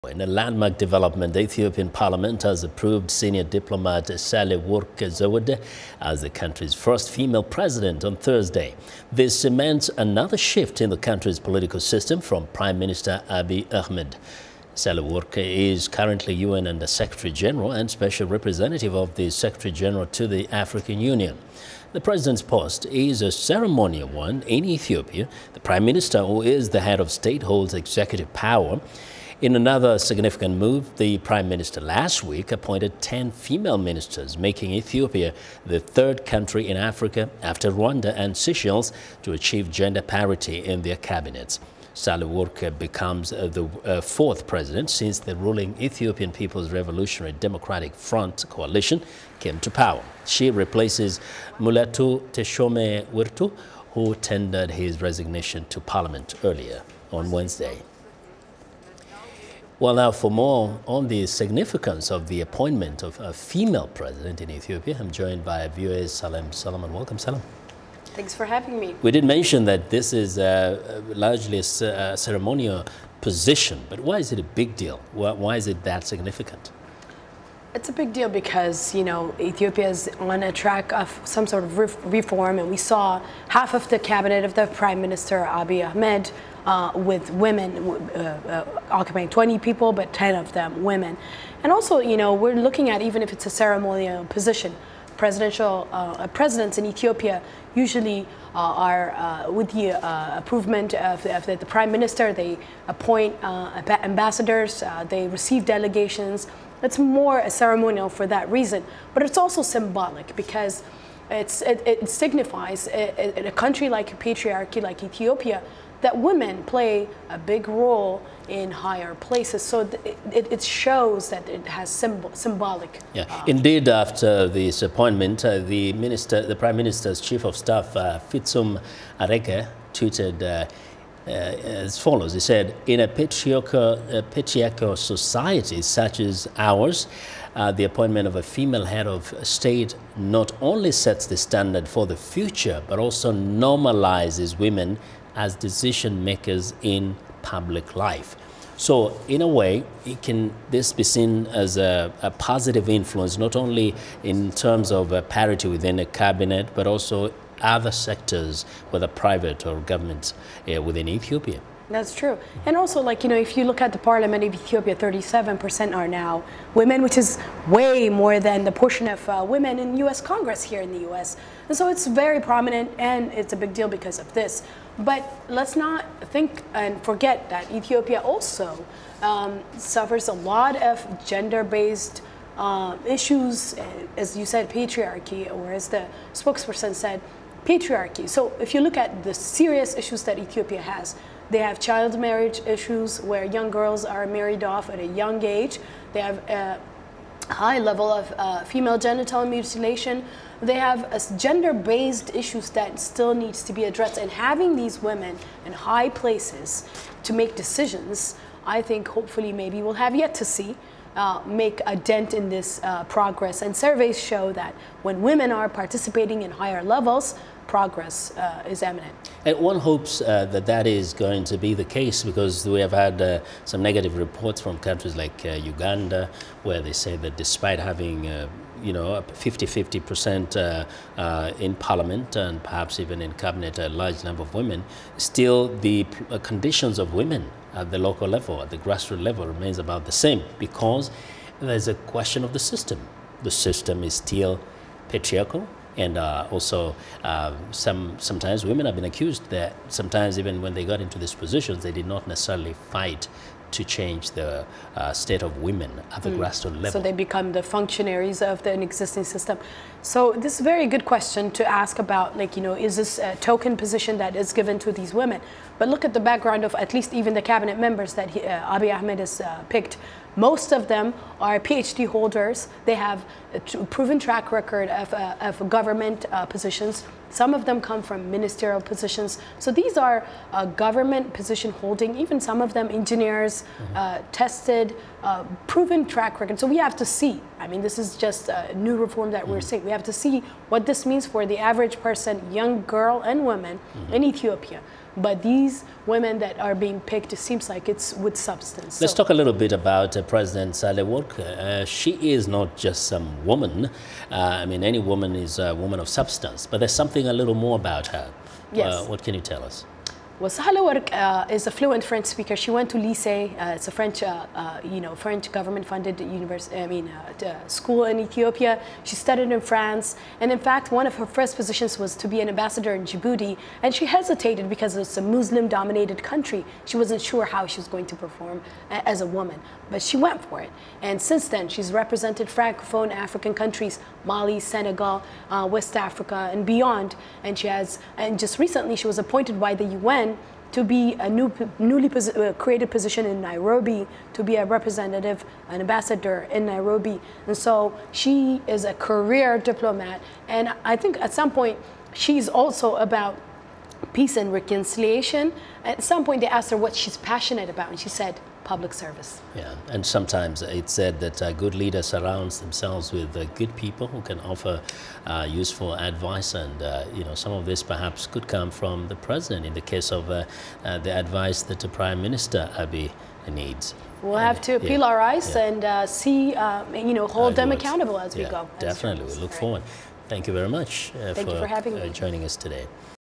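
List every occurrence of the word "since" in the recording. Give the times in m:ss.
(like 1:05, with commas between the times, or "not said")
0:44, 5:31.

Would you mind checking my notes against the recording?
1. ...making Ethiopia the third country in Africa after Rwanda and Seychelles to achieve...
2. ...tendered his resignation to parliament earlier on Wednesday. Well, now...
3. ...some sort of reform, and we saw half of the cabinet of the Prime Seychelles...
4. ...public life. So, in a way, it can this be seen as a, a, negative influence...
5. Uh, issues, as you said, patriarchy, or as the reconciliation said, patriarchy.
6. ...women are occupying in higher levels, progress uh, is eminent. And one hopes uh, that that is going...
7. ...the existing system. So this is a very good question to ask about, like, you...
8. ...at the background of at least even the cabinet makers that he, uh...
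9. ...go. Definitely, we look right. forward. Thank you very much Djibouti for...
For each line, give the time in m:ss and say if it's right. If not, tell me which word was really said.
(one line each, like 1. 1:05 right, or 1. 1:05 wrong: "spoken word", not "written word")
1. 0:34 right
2. 0:54 right
3. 1:21 wrong: "Minister", not "Seychelles"
4. 2:27 wrong: "positive", not "negative"
5. 3:02 wrong: "spokesperson", not "reconciliation"
6. 3:35 wrong: "participating", not "occupying"
7. 4:18 right
8. 4:26 wrong: "members", not "makers"
9. 6:18 wrong: "Thank", not "Djibouti".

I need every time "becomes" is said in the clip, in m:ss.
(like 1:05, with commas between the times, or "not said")
0:42, 4:17.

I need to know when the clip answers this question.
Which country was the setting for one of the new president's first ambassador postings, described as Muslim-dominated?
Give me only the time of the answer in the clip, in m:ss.
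5:23.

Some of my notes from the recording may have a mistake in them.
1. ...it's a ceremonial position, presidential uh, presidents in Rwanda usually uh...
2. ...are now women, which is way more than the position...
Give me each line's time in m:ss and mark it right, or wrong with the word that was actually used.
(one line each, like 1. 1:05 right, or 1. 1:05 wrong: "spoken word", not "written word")
1. 1:33 wrong: "Ethiopia", not "Rwanda"
2. 2:45 wrong: "portion", not "position".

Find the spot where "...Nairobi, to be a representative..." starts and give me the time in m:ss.
5:43.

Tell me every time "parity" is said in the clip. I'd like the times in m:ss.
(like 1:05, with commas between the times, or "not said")
0:40, 2:35.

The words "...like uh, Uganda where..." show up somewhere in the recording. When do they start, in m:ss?
3:45.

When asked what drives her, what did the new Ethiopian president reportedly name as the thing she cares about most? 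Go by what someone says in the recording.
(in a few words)
Public service.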